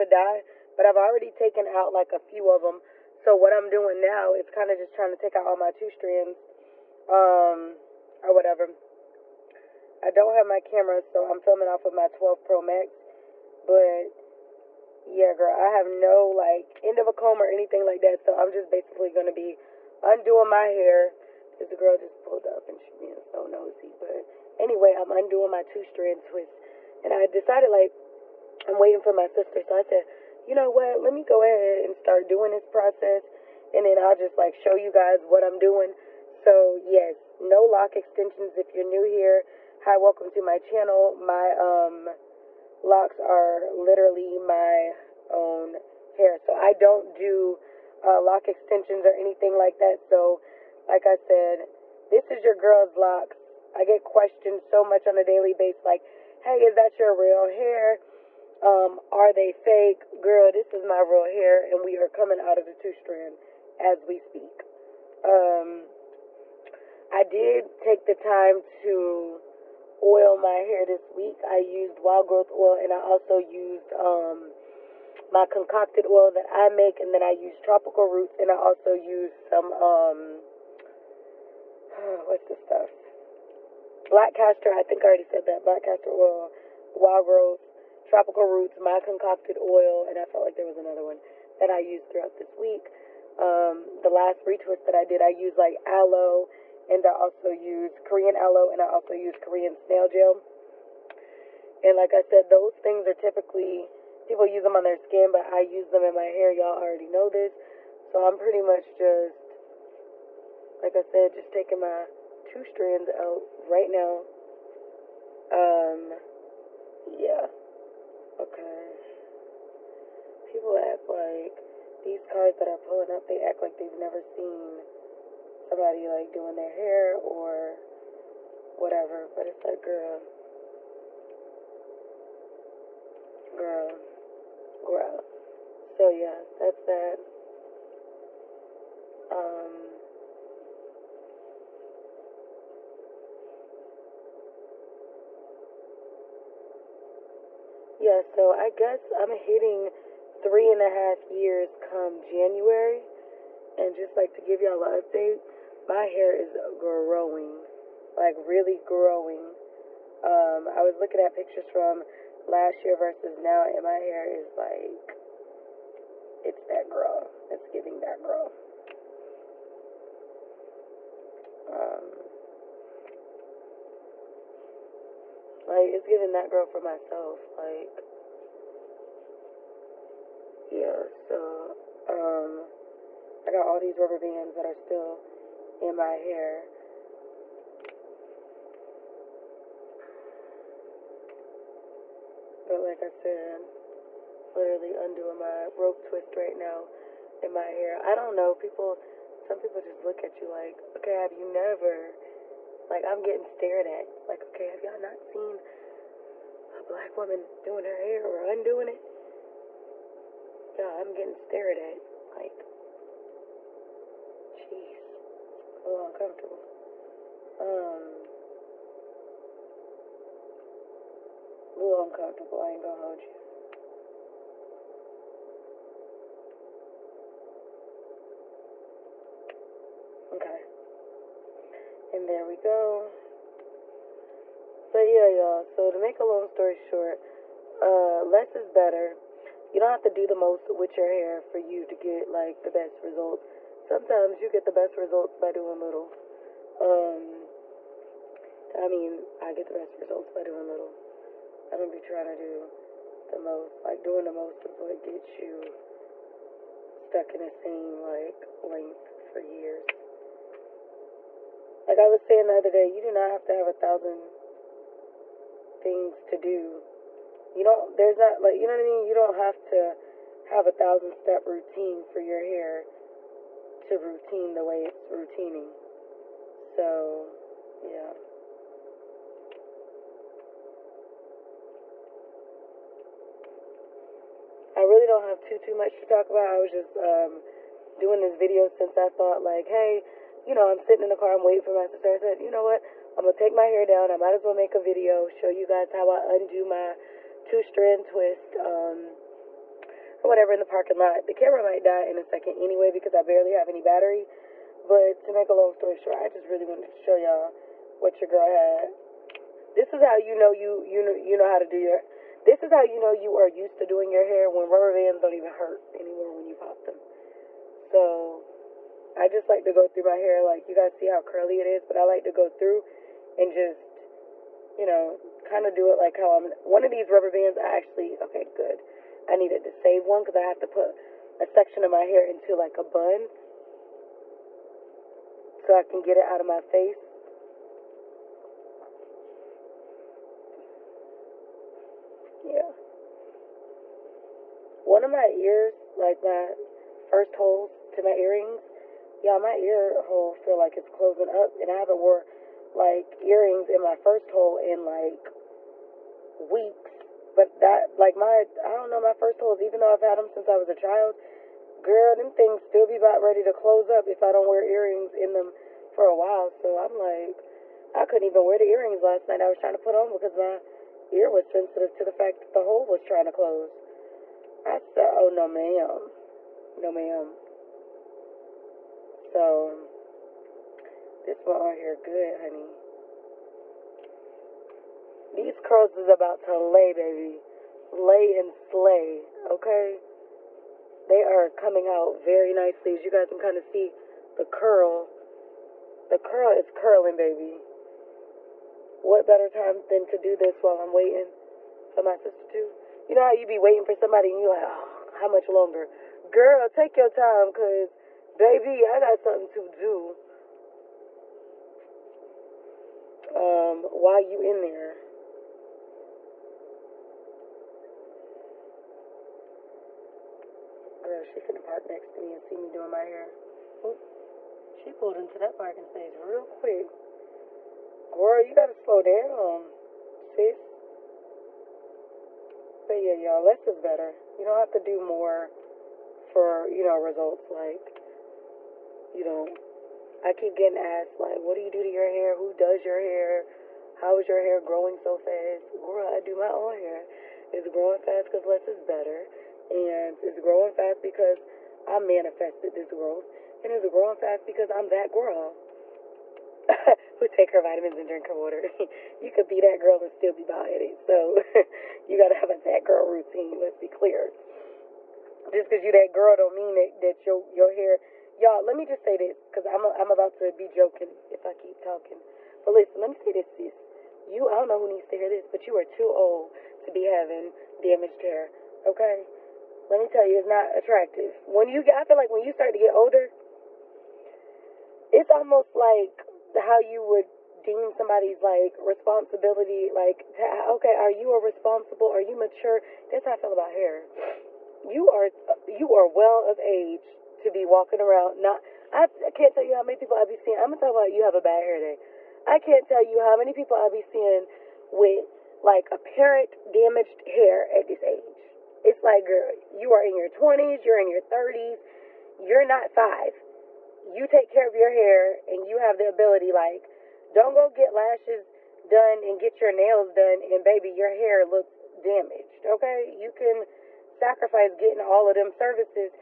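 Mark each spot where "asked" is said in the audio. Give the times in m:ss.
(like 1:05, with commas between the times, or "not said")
7:20.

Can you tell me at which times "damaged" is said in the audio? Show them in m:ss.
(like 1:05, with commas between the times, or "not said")
7:57, 8:26, 8:42.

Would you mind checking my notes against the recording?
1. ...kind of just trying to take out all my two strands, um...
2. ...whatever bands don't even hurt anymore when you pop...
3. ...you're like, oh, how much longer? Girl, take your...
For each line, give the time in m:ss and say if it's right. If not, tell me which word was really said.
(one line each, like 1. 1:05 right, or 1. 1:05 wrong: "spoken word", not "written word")
1. 0:04 right
2. 5:14 wrong: "rubber", not "whatever"
3. 6:44 right.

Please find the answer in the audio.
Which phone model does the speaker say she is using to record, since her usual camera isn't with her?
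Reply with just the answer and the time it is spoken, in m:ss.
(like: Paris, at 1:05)
12 Pro Max, at 0:12.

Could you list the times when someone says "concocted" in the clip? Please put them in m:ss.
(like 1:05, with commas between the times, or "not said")
1:15, 1:29.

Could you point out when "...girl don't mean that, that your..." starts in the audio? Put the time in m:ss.
7:46.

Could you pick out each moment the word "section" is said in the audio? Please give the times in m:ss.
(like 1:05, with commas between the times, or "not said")
5:31.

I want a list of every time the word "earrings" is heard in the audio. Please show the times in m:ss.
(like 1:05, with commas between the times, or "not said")
5:48, 5:53, 6:04, 6:08.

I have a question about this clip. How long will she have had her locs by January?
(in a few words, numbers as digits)
3.5.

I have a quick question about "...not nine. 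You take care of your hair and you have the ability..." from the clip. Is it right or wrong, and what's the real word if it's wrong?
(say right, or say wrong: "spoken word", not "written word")
wrong: "five", not "nine".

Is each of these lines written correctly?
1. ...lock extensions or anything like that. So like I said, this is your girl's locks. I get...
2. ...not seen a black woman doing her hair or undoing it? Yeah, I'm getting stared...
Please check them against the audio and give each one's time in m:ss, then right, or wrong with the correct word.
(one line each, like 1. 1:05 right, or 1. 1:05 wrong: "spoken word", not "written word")
1. 0:48 right
2. 3:24 right.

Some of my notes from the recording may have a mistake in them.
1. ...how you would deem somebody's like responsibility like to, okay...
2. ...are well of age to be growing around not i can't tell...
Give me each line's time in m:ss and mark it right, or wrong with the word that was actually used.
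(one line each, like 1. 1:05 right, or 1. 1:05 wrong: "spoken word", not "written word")
1. 8:06 right
2. 8:15 wrong: "walking", not "growing".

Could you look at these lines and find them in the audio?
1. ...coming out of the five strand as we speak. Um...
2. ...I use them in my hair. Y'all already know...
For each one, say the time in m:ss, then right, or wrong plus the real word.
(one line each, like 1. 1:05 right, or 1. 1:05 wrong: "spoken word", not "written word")
1. 1:02 wrong: "two", not "five"
2. 1:45 right.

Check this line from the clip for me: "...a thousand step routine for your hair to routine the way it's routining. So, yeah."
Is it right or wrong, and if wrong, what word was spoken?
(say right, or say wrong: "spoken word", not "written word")
right.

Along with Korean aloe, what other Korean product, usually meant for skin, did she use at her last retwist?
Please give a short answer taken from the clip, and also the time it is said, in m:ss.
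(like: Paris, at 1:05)
Korean snail gel, at 1:39.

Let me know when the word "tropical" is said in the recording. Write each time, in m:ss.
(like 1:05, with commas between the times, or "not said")
1:17, 1:28.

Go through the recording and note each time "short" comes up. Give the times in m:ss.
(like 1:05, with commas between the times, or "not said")
3:56, 5:05.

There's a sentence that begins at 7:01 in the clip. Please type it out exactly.
Girl, she finna park next to me and see me doing my hair.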